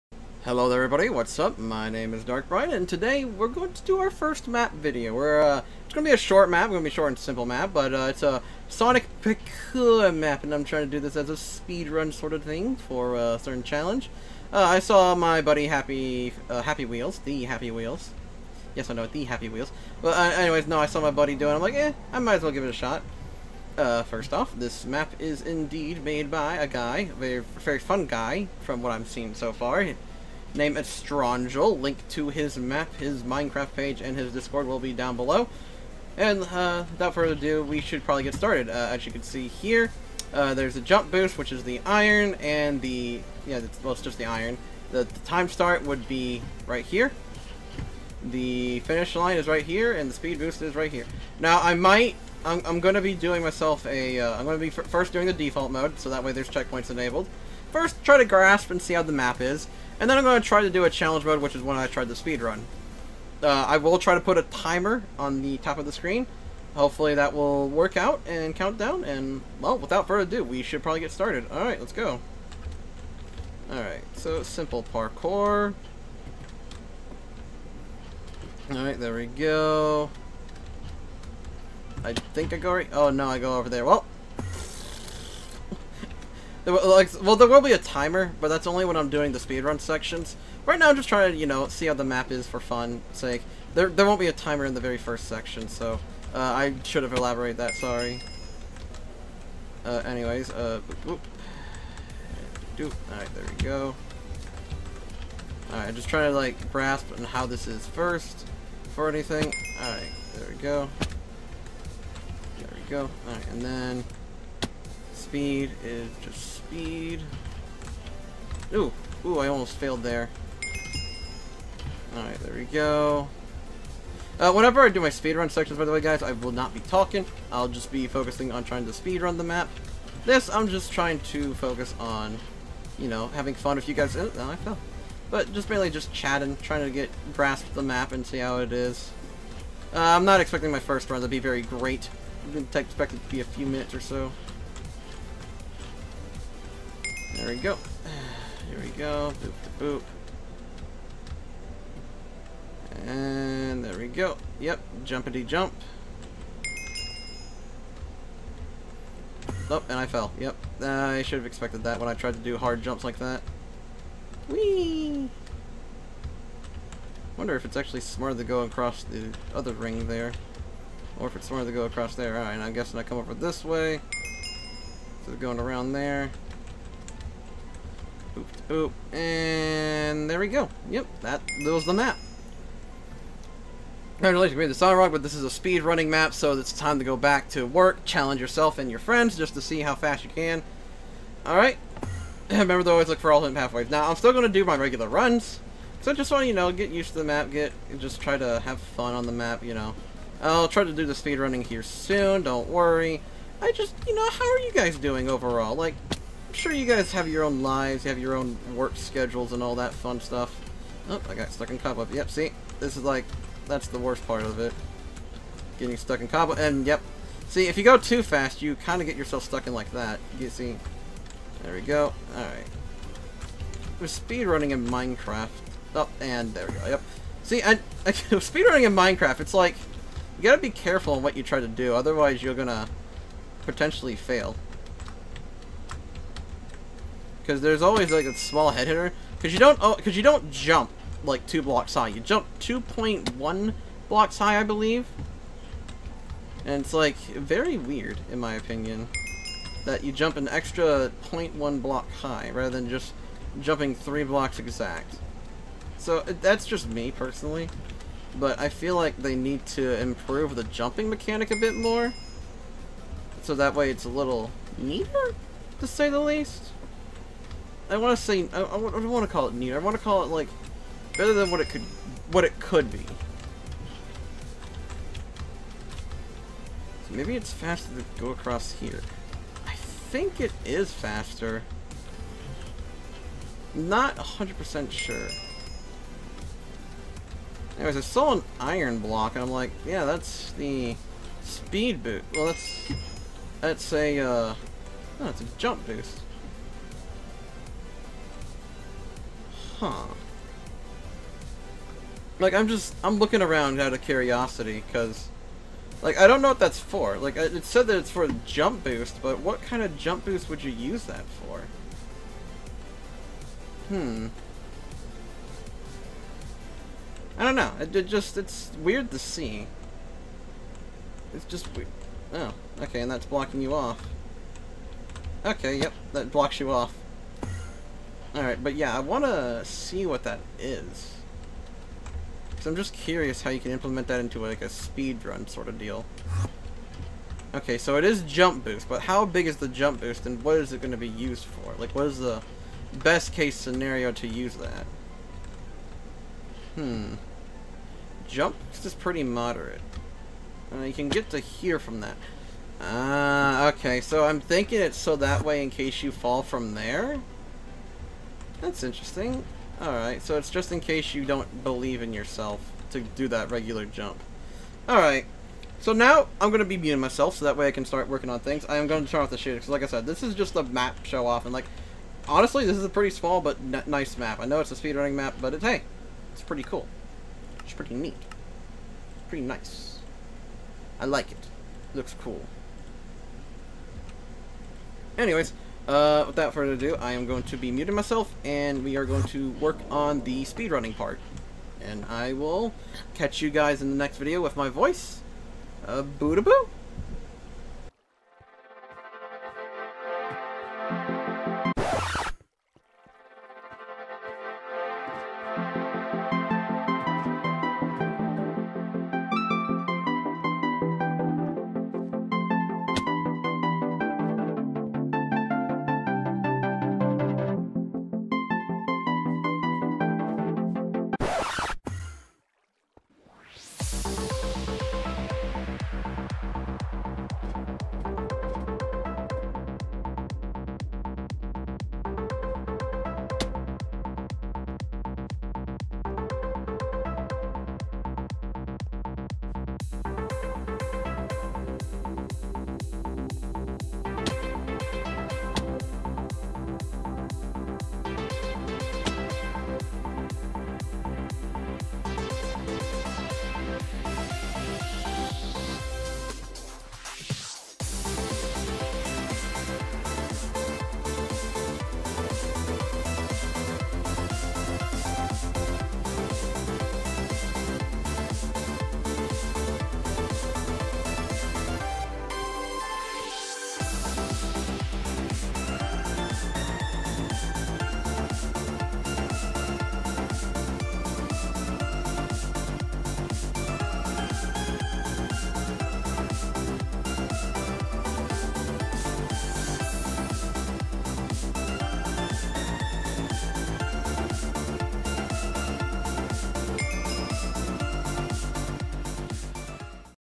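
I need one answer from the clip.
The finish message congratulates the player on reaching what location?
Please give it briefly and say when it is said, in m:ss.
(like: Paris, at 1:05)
the Sun Rock, at 3:04.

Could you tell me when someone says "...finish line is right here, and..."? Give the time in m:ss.
0:48.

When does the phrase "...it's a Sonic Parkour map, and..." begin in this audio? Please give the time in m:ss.
0:08.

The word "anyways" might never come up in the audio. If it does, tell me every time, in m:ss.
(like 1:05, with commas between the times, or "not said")
0:20, 1:40, 4:47, 6:25.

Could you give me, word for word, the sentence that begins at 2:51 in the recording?
Or if it's smarter to go across there.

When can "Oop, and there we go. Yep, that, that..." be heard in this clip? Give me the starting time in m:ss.
2:58.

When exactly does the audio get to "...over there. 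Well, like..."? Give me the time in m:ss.
1:23.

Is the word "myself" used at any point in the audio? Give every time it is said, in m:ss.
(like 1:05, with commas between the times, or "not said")
0:53, 6:06, 6:27.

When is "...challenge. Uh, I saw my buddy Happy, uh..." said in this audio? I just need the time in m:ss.
0:13.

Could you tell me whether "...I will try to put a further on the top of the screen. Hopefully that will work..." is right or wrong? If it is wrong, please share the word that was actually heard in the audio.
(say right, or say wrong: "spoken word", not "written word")
wrong: "timer", not "further".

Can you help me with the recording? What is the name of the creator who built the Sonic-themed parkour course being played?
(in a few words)
Estrangel.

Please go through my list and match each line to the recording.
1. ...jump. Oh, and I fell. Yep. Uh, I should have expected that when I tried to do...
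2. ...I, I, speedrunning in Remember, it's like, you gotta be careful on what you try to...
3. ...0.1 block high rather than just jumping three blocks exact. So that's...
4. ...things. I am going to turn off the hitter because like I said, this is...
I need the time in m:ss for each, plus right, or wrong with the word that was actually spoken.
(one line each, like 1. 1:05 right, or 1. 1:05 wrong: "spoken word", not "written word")
1. 2:35 right
2. 3:47 wrong: "Minecraft", not "Remember"
3. 4:11 right
4. 6:08 wrong: "shooter", not "hitter".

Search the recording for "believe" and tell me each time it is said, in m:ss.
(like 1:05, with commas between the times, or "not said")
4:04, 6:01.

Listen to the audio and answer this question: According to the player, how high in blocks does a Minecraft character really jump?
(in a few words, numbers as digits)
2.1 blocks.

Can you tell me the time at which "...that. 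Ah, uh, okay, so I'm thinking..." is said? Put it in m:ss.
5:51.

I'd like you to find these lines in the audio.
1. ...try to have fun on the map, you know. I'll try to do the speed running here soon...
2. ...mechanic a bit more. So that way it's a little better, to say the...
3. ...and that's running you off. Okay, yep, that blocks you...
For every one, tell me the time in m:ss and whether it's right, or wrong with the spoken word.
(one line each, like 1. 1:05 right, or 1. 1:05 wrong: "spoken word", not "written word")
1. 3:18 right
2. 4:21 wrong: "neater", not "better"
3. 5:23 wrong: "blocking", not "running".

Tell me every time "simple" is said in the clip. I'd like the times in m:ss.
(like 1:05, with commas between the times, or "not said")
0:07, 1:14.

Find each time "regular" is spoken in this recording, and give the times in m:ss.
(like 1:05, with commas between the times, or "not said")
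3:14, 6:03.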